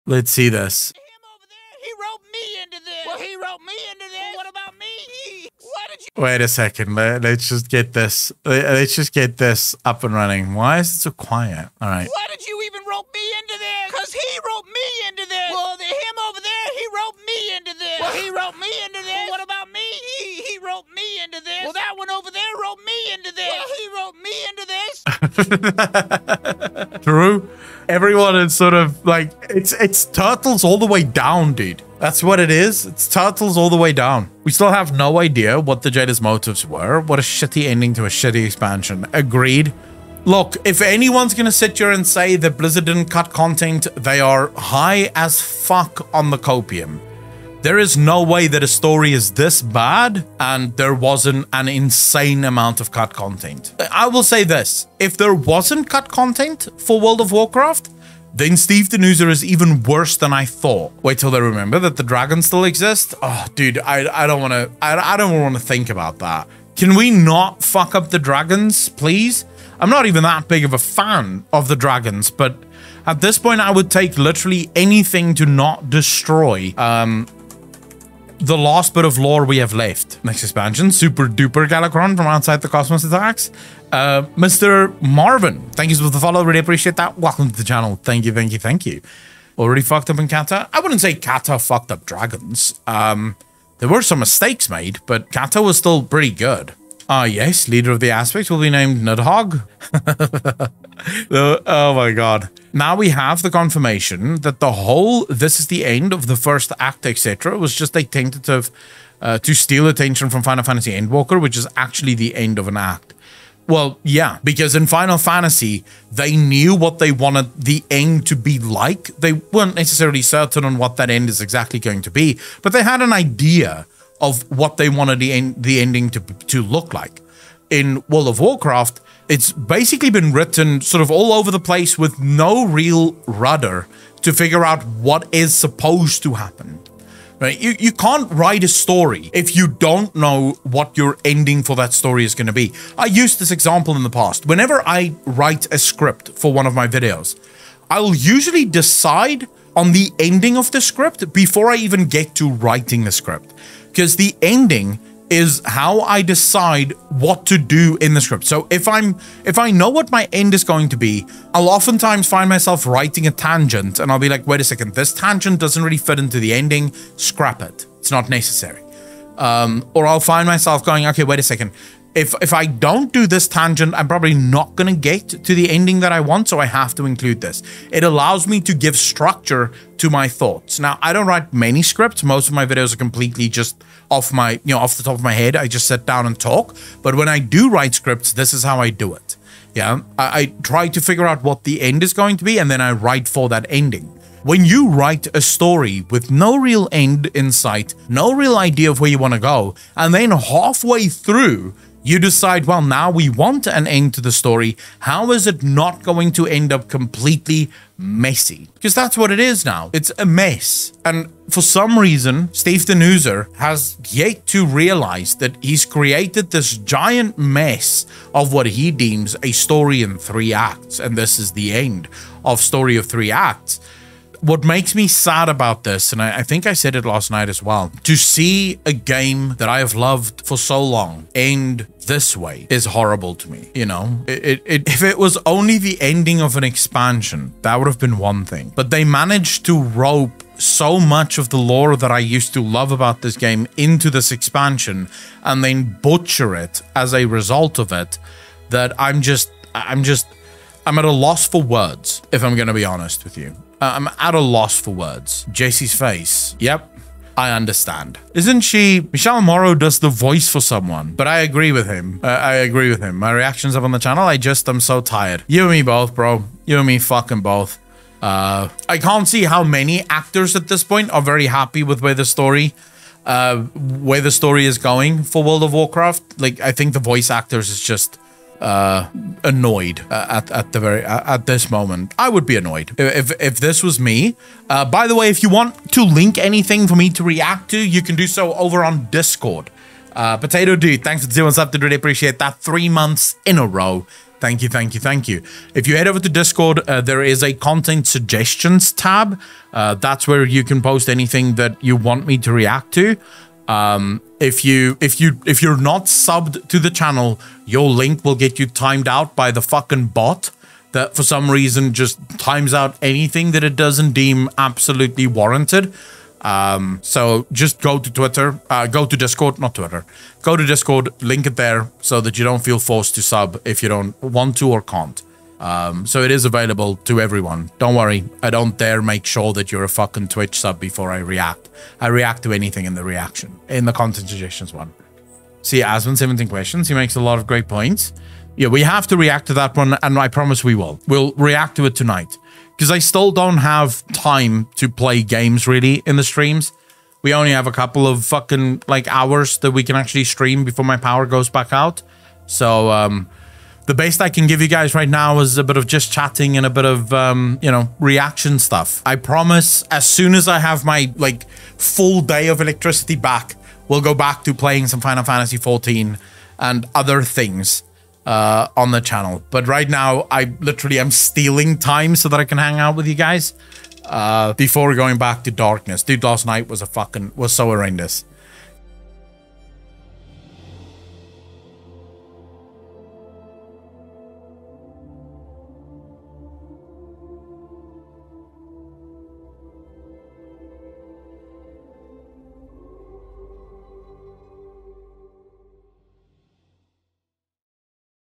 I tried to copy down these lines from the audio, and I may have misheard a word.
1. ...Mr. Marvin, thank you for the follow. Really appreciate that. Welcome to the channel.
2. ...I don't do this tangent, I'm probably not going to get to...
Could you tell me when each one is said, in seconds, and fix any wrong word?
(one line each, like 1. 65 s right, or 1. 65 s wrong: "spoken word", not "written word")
1. 84 s right
2. 172 s right.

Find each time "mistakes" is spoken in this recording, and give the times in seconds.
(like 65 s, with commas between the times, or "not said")
94 s.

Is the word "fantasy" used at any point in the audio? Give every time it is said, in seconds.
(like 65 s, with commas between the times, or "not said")
110 s, 115 s, 365 s.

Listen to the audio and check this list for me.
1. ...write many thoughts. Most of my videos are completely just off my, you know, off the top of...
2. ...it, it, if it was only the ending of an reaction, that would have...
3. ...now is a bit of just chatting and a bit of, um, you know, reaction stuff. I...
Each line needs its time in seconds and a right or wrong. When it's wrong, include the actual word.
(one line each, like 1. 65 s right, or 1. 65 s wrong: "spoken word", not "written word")
1. 181 s wrong: "scripts", not "thoughts"
2. 234 s wrong: "expansion", not "reaction"
3. 355 s right.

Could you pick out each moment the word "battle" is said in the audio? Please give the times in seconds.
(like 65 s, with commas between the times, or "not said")
not said.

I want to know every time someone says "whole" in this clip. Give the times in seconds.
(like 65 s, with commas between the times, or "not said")
104 s.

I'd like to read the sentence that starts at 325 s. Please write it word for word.
Um, so it is available to everyone.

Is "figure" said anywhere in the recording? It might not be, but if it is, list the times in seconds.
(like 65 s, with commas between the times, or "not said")
134 s, 190 s.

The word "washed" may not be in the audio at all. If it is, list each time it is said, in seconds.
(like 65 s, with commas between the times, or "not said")
not said.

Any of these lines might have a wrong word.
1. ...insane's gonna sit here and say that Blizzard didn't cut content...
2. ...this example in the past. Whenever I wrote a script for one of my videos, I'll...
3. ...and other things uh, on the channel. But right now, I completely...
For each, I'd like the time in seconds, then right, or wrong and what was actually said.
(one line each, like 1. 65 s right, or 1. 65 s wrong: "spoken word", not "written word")
1. 40 s wrong: "anyone", not "insane"
2. 143 s wrong: "write", not "wrote"
3. 366 s wrong: "literally", not "completely".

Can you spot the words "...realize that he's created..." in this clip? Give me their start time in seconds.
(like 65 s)
214 s.